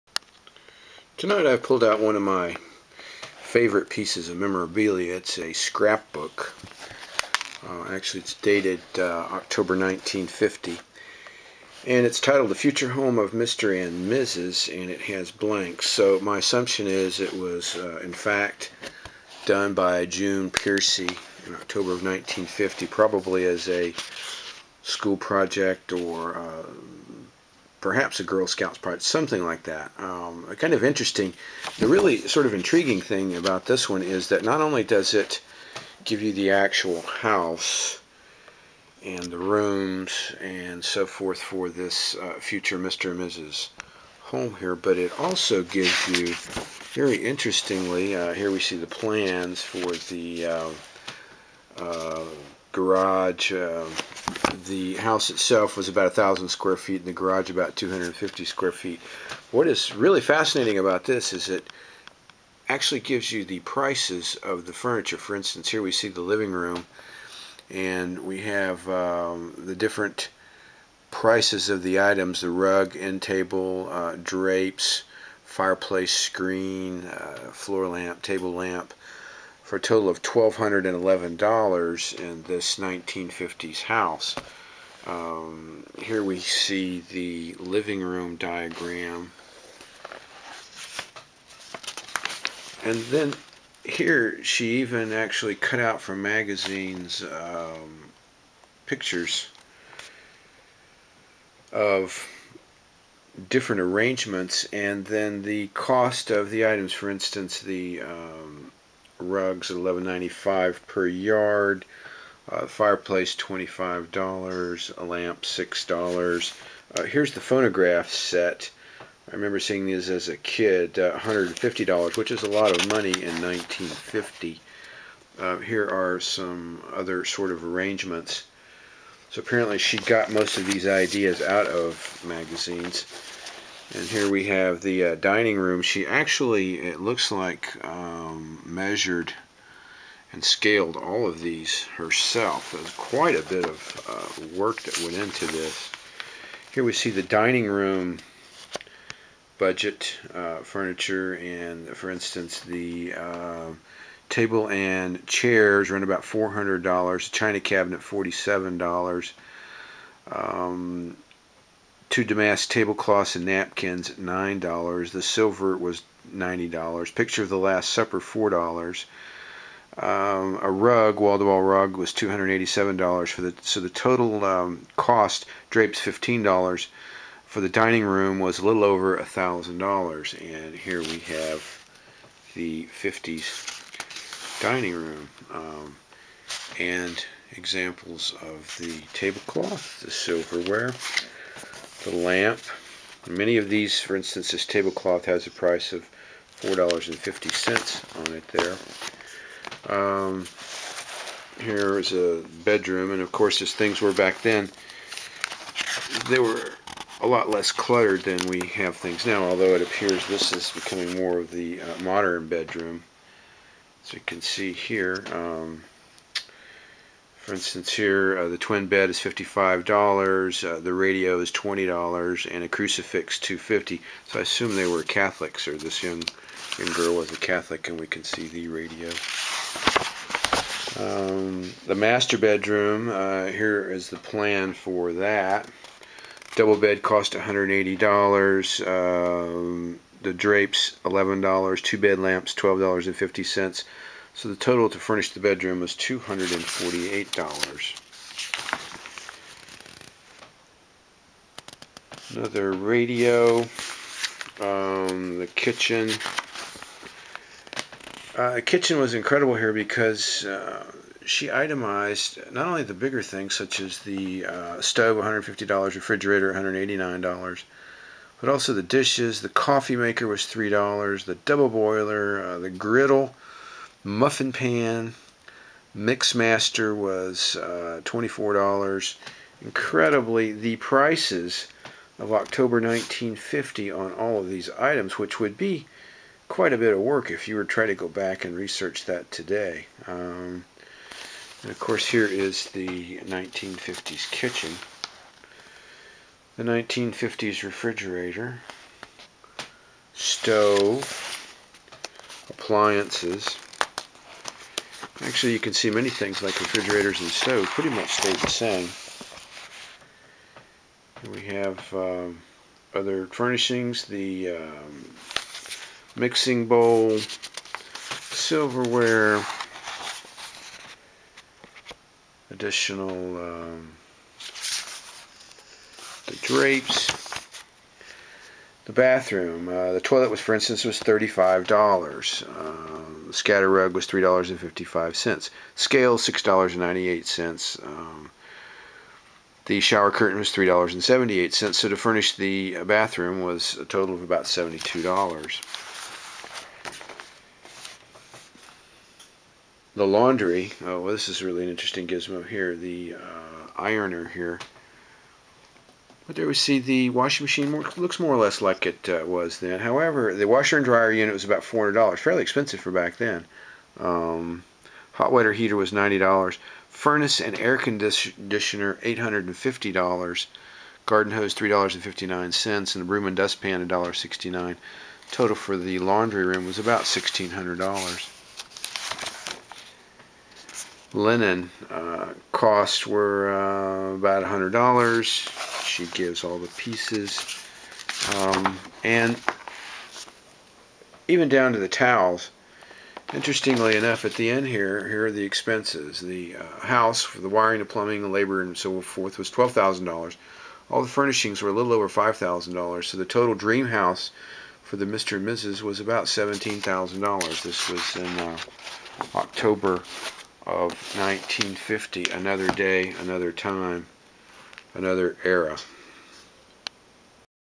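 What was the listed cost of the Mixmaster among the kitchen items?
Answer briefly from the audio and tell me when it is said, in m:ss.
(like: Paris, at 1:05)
$24, at 4:38.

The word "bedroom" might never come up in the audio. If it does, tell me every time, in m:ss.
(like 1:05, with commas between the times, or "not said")
3:22, 3:32, 3:52, 4:05.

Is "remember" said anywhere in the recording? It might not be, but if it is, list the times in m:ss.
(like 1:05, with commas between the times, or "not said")
1:59.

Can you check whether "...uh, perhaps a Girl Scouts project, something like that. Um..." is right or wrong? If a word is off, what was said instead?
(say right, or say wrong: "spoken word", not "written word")
right.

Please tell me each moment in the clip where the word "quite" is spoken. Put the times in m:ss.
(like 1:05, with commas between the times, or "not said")
2:22, 4:46.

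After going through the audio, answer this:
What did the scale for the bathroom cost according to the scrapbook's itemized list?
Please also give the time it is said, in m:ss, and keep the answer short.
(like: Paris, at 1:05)
$6.98, at 5:36.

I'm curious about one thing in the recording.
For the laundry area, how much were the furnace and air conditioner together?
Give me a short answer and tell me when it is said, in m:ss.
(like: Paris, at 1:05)
$850, at 6:09.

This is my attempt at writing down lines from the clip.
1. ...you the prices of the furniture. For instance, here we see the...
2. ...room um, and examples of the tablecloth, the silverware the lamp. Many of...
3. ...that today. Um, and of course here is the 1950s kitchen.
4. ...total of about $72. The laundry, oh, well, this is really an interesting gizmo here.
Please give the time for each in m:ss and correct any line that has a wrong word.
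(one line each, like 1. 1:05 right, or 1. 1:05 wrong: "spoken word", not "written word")
1. 1:03 right
2. 3:04 right
3. 4:49 right
4. 5:43 right.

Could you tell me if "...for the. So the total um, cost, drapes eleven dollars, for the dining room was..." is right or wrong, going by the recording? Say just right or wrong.
wrong.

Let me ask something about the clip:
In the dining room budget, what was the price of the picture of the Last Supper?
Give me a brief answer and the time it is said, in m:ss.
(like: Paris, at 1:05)
$4, at 2:48.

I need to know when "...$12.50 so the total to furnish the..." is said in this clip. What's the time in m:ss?
4:02.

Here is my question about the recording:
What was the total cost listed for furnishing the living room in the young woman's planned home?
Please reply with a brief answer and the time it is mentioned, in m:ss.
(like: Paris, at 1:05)
$1,211, at 1:20.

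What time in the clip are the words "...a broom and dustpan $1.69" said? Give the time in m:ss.
6:13.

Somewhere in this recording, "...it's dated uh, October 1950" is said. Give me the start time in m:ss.
0:08.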